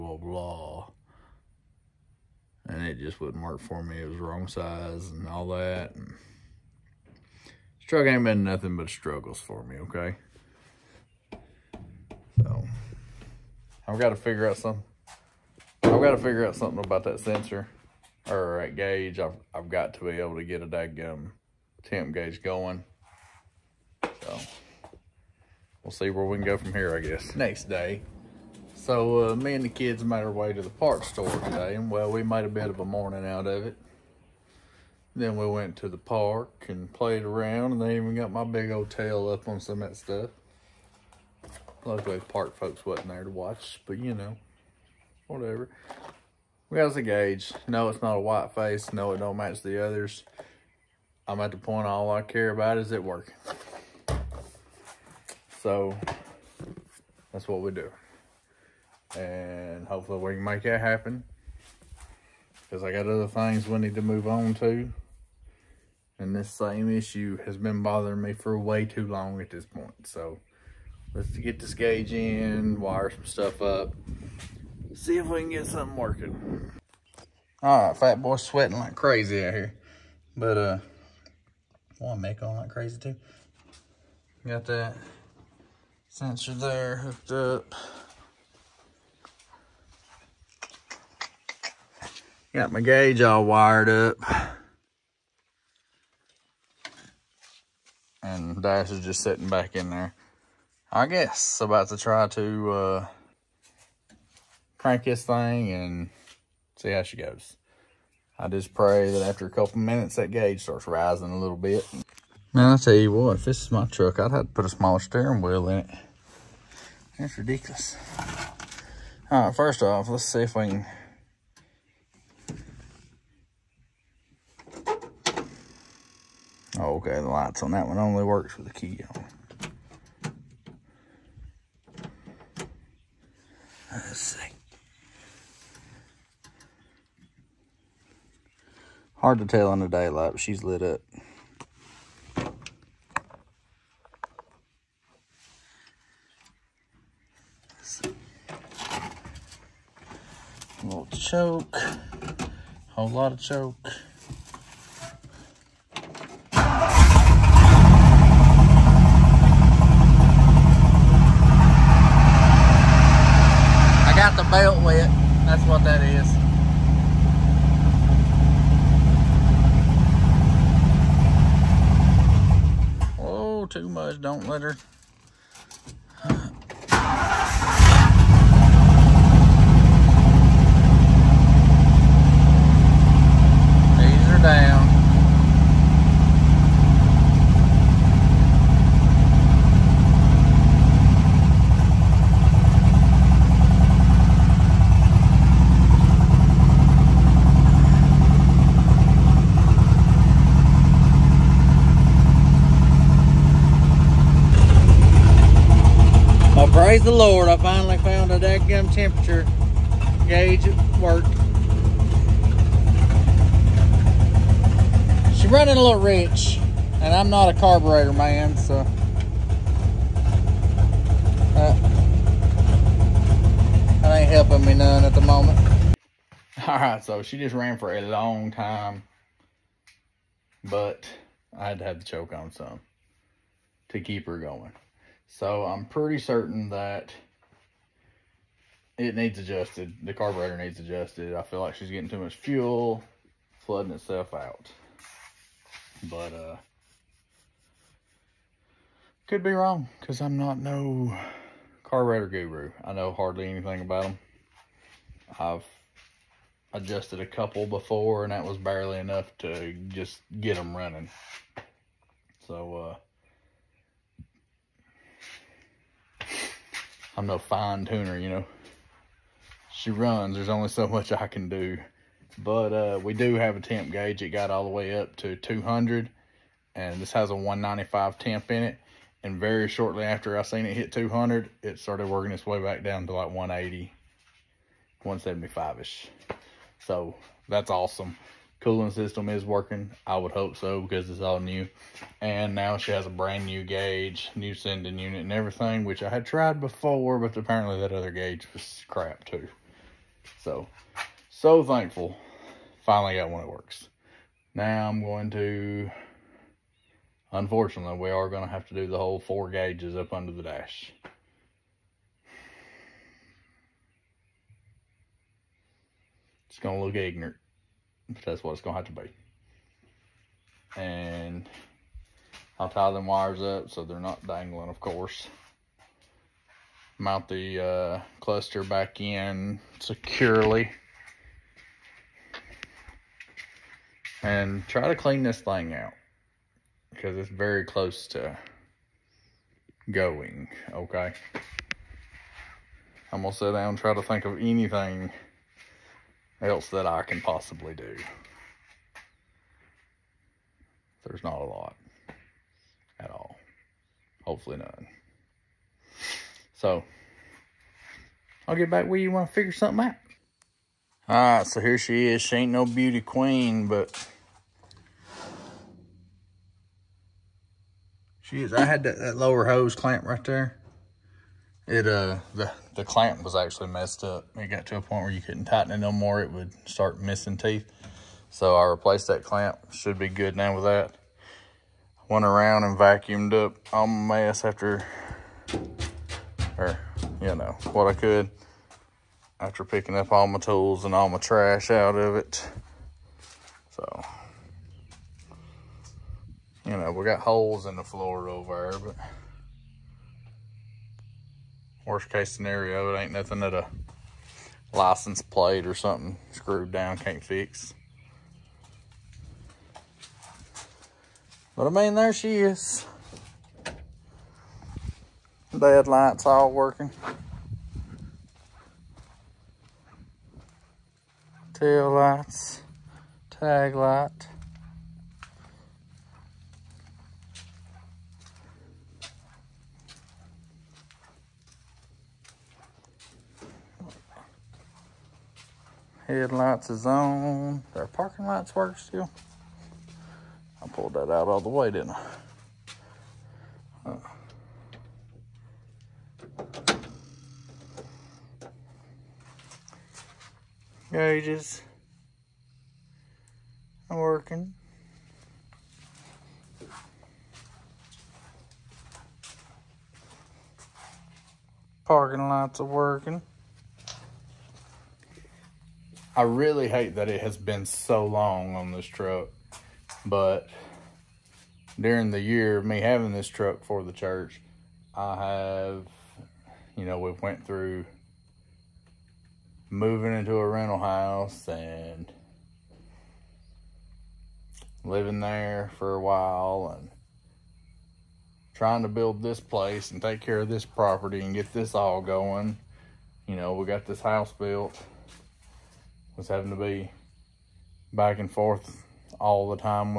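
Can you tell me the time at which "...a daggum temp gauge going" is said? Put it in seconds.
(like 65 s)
20 s.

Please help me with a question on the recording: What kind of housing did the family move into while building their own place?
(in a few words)
a rental house.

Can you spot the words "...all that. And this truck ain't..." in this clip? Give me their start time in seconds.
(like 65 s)
5 s.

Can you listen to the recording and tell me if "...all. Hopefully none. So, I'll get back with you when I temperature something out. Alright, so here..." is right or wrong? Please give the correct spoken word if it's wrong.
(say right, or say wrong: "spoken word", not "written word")
wrong: "figure", not "temperature".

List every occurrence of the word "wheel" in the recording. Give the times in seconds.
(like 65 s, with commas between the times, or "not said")
115 s.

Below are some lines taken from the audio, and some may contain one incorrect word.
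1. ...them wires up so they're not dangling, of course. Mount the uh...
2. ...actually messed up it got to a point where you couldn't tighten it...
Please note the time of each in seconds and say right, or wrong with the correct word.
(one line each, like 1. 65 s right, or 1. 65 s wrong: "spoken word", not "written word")
1. 322 s right
2. 373 s right.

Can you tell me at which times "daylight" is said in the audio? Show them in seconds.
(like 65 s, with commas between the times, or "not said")
139 s.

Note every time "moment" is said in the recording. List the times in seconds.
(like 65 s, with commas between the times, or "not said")
225 s.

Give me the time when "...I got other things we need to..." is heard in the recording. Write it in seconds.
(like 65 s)
62 s.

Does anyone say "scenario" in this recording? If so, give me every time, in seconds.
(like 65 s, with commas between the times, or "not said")
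402 s.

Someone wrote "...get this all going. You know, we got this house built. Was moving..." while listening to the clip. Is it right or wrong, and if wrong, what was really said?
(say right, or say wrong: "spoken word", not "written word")
wrong: "having", not "moving".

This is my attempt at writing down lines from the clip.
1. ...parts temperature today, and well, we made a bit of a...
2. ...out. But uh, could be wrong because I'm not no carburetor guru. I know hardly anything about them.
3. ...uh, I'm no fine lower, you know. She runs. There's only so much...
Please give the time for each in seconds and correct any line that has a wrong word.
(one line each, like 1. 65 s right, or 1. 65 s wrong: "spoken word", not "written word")
1. 30 s wrong: "store", not "temperature"
2. 244 s right
3. 262 s wrong: "tuner", not "lower".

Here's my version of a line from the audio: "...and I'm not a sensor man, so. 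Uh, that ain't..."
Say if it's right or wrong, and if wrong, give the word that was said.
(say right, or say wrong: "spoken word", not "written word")
wrong: "carburetor", not "sensor".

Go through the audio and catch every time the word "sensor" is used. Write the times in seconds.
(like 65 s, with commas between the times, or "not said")
17 s, 86 s.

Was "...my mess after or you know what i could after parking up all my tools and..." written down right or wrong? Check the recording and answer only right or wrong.
wrong.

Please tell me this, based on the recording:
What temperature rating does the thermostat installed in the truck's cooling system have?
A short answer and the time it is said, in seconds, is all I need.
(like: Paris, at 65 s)
195, at 277 s.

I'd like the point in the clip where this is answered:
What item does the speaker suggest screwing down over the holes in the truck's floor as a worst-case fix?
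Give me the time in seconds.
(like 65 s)
404 s.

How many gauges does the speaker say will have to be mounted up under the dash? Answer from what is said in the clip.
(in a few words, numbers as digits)
four.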